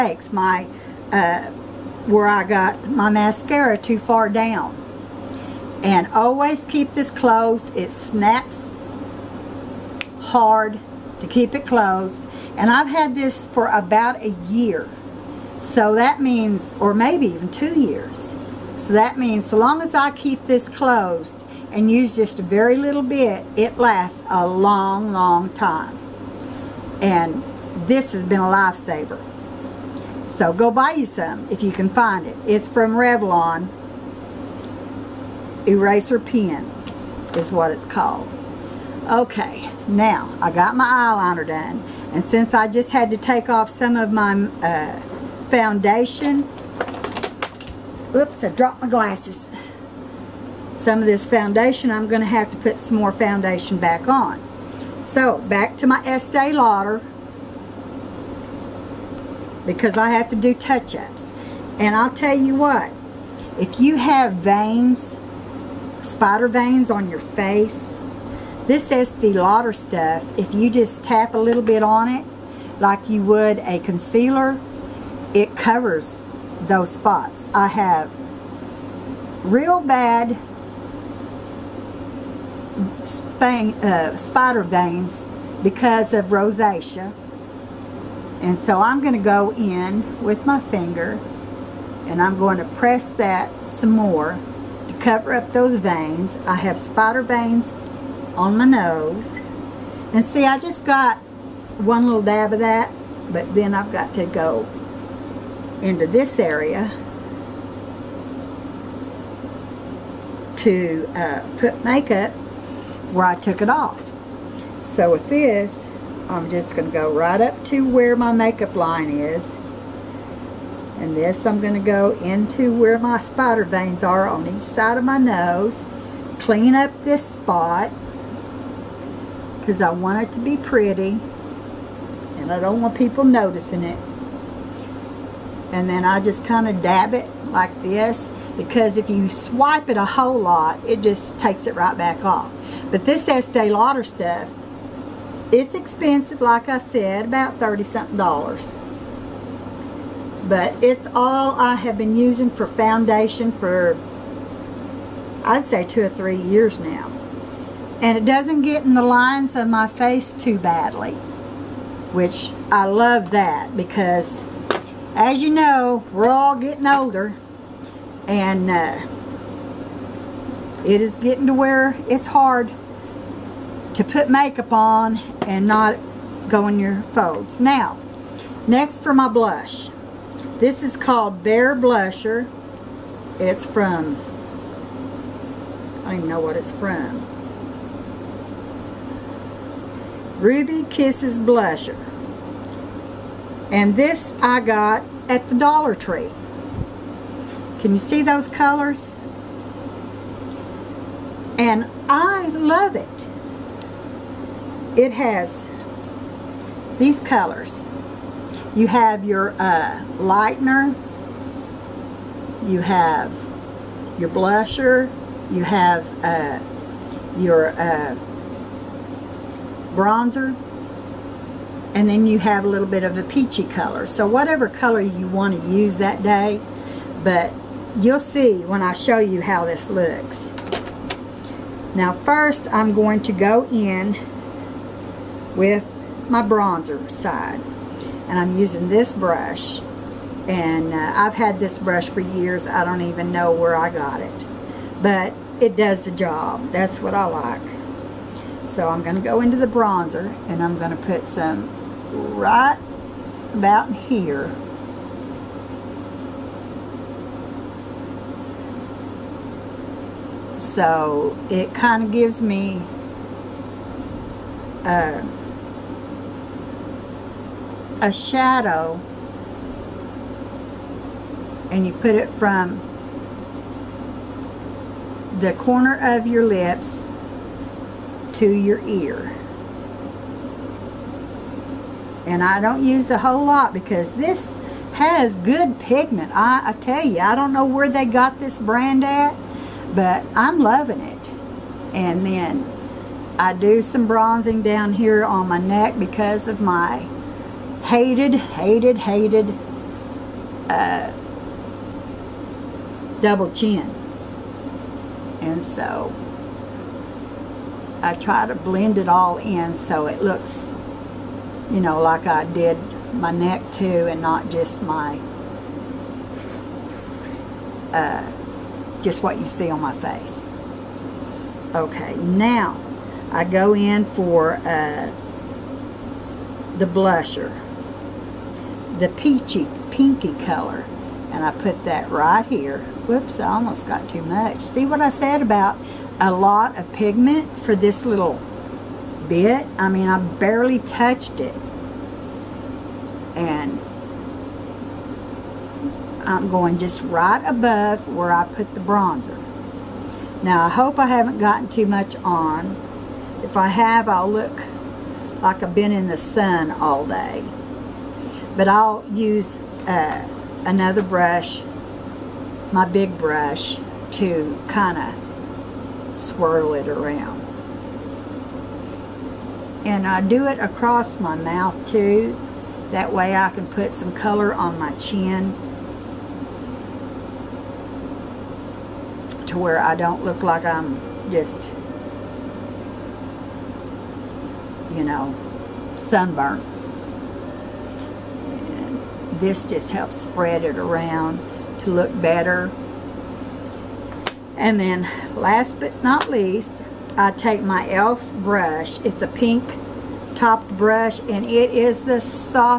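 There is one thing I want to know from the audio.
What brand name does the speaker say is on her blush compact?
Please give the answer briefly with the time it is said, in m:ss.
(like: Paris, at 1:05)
Ruby Kisses, at 3:10.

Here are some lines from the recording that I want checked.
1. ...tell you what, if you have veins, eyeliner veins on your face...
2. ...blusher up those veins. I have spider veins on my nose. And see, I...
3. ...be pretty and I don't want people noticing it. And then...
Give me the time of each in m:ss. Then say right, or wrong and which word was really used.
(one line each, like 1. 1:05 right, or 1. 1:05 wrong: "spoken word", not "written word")
1. 1:02 wrong: "spider", not "eyeliner"
2. 1:35 wrong: "cover", not "blusher"
3. 2:10 right.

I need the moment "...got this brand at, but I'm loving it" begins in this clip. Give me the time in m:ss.
4:48.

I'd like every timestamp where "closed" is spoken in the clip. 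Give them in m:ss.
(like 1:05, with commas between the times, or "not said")
0:07, 0:11, 0:20.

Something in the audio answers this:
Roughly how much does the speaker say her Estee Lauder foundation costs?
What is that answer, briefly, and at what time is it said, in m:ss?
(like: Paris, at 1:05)
30 something dollars, at 2:27.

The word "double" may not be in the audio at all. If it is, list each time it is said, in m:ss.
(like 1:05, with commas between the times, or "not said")
5:03.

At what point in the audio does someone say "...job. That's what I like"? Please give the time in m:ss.
4:06.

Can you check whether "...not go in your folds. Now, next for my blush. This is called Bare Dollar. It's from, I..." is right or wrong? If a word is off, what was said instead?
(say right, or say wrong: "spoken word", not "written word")
wrong: "Blusher", not "Dollar".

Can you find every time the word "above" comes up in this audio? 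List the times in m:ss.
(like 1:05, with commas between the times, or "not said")
5:47.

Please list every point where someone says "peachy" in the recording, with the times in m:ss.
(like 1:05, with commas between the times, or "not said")
3:43, 5:29.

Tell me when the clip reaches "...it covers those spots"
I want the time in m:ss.
1:15.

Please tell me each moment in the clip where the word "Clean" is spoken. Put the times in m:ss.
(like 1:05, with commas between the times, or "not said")
2:06.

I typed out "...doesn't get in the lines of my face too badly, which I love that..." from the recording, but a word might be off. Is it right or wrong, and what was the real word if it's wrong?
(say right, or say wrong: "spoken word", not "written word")
right.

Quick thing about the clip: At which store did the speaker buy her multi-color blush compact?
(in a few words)
Dollar Tree.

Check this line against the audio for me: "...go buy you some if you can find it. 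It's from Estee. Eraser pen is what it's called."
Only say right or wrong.
wrong.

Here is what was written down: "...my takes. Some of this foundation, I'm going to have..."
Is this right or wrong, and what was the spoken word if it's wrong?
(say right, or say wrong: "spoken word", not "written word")
wrong: "glasses", not "takes".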